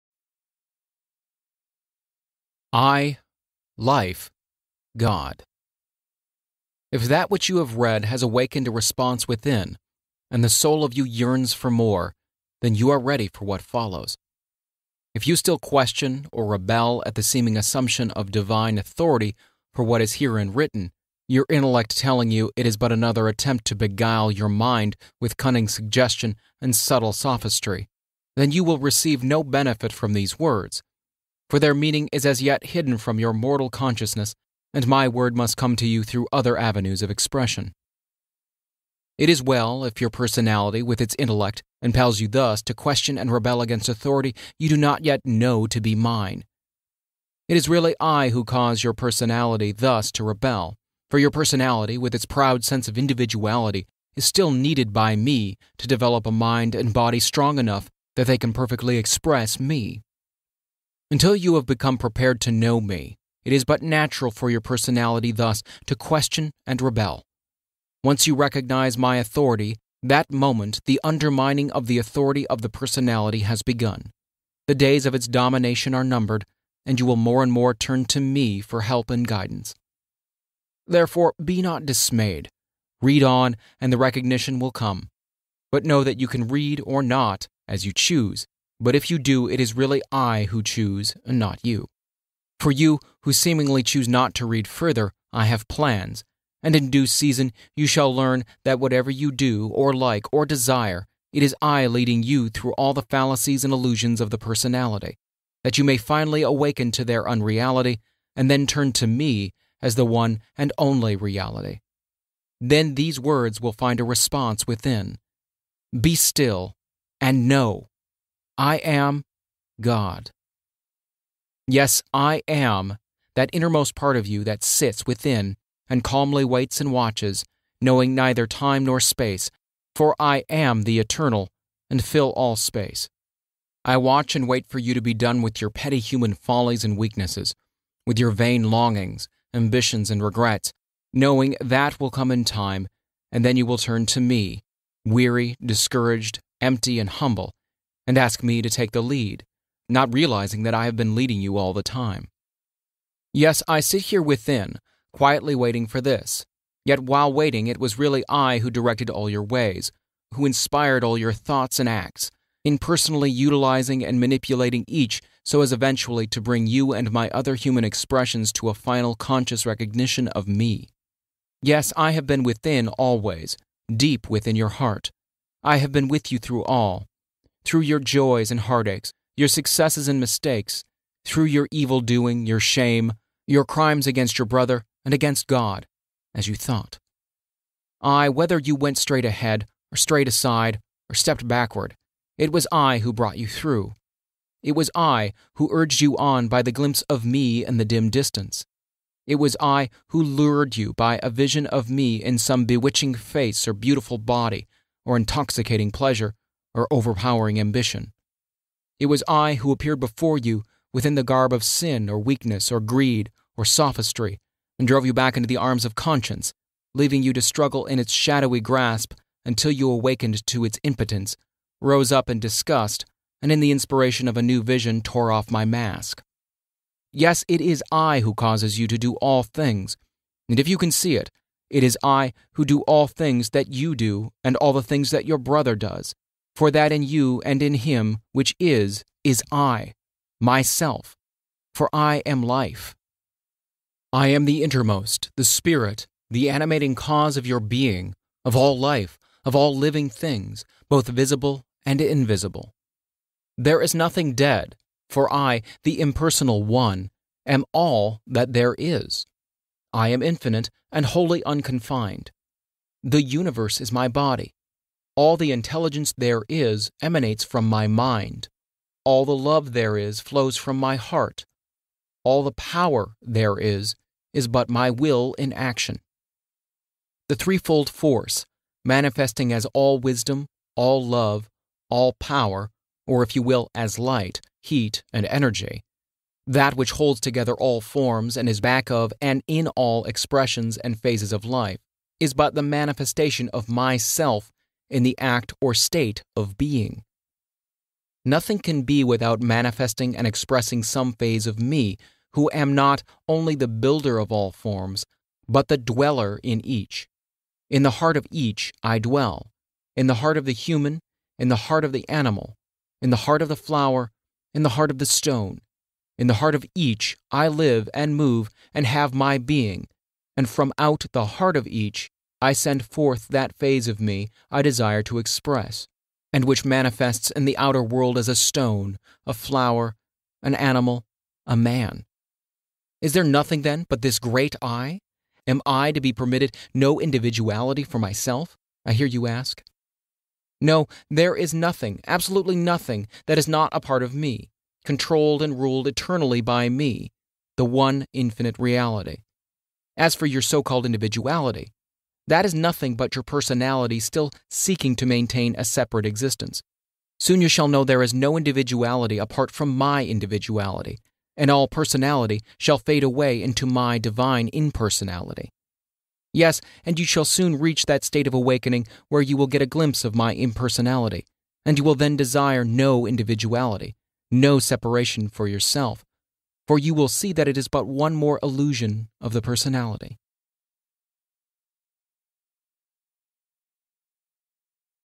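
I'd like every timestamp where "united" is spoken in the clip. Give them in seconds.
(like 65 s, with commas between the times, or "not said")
not said.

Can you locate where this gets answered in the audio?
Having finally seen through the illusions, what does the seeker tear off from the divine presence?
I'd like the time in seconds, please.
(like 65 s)
225 s.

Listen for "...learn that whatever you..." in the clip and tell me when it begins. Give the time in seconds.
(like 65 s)
98 s.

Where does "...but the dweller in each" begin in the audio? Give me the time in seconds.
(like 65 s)
305 s.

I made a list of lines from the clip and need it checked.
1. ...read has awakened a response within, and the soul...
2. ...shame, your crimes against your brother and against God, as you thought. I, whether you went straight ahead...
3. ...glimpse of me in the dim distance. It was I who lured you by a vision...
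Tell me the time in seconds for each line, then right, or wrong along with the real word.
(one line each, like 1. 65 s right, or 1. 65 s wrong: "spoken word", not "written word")
1. 7 s right
2. 182 s right
3. 196 s right.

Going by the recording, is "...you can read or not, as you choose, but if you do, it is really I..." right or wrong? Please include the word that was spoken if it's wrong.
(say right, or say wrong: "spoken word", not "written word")
right.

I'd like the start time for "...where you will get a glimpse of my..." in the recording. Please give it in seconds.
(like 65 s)
369 s.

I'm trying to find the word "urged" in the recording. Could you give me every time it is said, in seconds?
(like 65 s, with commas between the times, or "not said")
195 s.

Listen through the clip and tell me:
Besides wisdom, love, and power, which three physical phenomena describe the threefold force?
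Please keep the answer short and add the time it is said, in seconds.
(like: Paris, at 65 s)
light, heat, and energy, at 283 s.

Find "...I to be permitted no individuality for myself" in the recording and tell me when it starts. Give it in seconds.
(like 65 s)
335 s.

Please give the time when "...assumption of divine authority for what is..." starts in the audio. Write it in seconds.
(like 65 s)
17 s.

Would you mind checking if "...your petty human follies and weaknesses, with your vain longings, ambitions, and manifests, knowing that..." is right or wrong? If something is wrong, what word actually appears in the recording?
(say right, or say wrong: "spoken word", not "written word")
wrong: "regrets", not "manifests".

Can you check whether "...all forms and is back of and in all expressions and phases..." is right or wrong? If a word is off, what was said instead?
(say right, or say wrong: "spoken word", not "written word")
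right.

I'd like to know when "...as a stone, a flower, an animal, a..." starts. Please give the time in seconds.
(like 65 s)
328 s.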